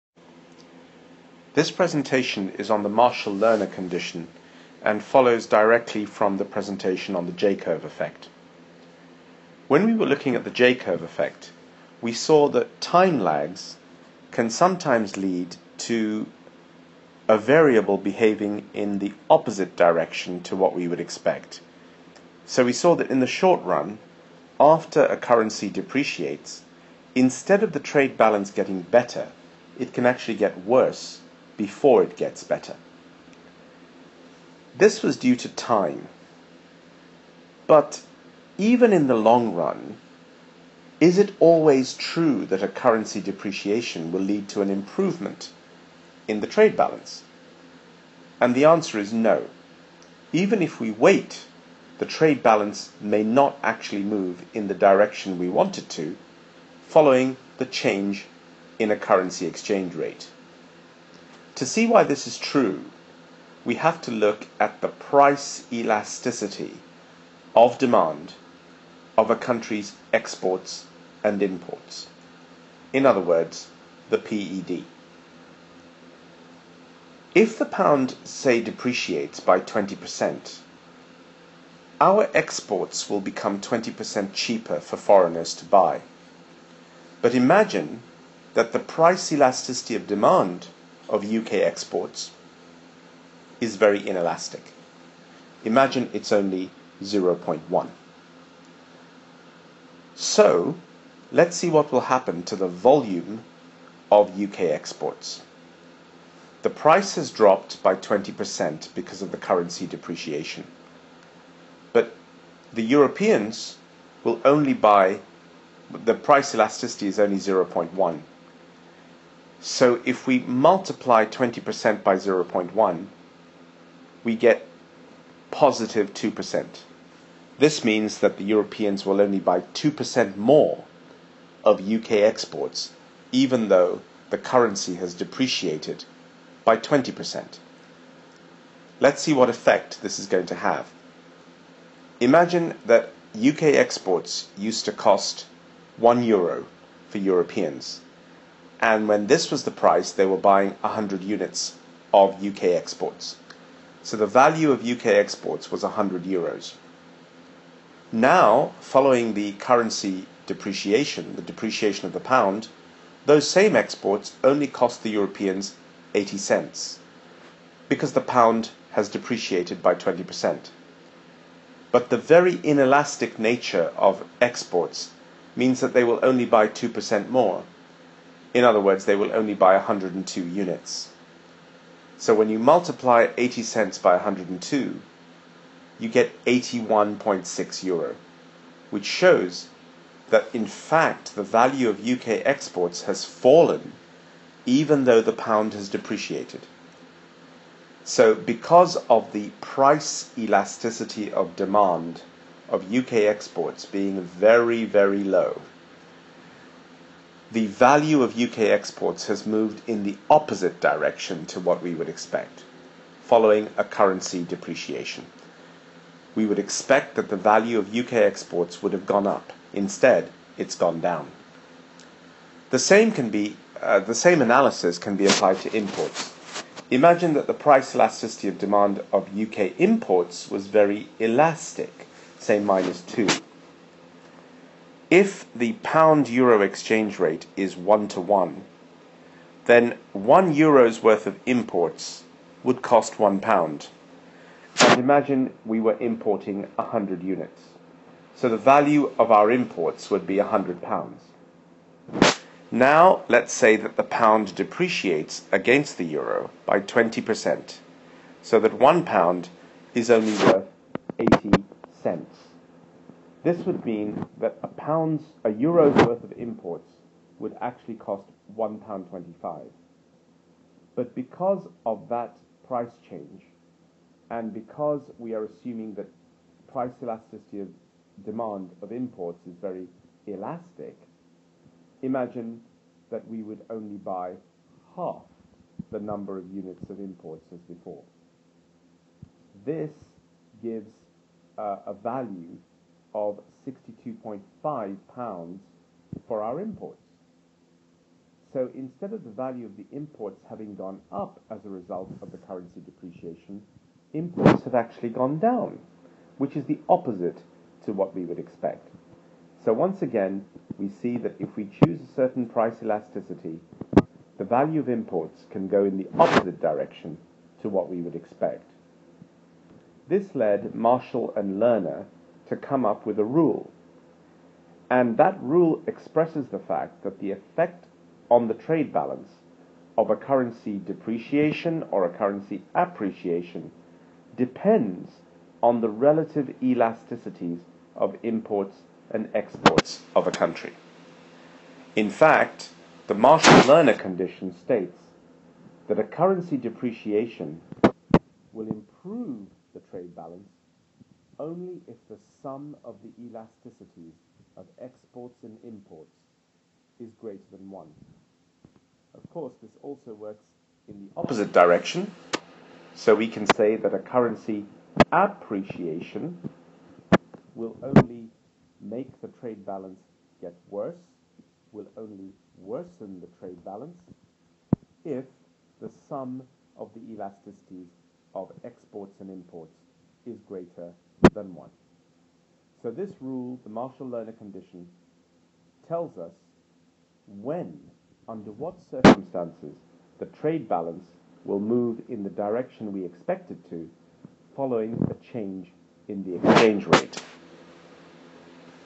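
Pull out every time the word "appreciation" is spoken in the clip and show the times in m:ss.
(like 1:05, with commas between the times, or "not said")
5:32, 6:05.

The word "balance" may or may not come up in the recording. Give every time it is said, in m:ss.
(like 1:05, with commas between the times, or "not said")
0:28, 0:46, 0:52, 5:28, 5:50, 6:09, 6:13, 6:30.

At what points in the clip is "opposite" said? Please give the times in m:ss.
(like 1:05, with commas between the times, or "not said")
0:19, 3:30, 5:06, 5:16, 6:01.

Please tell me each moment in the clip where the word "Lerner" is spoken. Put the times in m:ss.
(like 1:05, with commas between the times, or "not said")
0:02, 5:21, 5:43, 6:23.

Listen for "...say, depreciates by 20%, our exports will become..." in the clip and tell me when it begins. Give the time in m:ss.
1:18.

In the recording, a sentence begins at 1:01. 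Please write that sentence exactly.
To see why this is true, we have to look at the price elasticity of demand of a country's exports and imports.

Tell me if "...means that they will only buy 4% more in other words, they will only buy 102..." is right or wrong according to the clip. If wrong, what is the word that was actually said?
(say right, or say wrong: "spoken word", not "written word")
wrong: "2", not "4".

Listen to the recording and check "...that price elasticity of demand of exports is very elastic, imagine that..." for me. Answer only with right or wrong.
wrong.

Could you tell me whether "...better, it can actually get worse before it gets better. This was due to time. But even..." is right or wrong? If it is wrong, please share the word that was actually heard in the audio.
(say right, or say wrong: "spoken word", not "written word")
right.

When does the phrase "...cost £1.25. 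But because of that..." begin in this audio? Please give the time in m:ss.
4:27.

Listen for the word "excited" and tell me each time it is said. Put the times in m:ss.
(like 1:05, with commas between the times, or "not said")
not said.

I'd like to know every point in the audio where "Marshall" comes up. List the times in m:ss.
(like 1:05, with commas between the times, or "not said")
0:02, 5:20, 5:43, 6:23.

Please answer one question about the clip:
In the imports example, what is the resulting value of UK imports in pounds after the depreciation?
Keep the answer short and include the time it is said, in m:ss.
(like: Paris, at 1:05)
62.5 pounds, at 4:53.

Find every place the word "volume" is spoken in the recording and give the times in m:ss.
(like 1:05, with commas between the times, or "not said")
1:42.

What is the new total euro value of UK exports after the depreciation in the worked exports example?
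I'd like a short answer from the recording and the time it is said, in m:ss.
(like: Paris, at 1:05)
81.6 euro, at 3:06.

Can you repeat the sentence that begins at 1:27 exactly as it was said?
But imagine that the price elasticity of demand of UK exports is very inelastic.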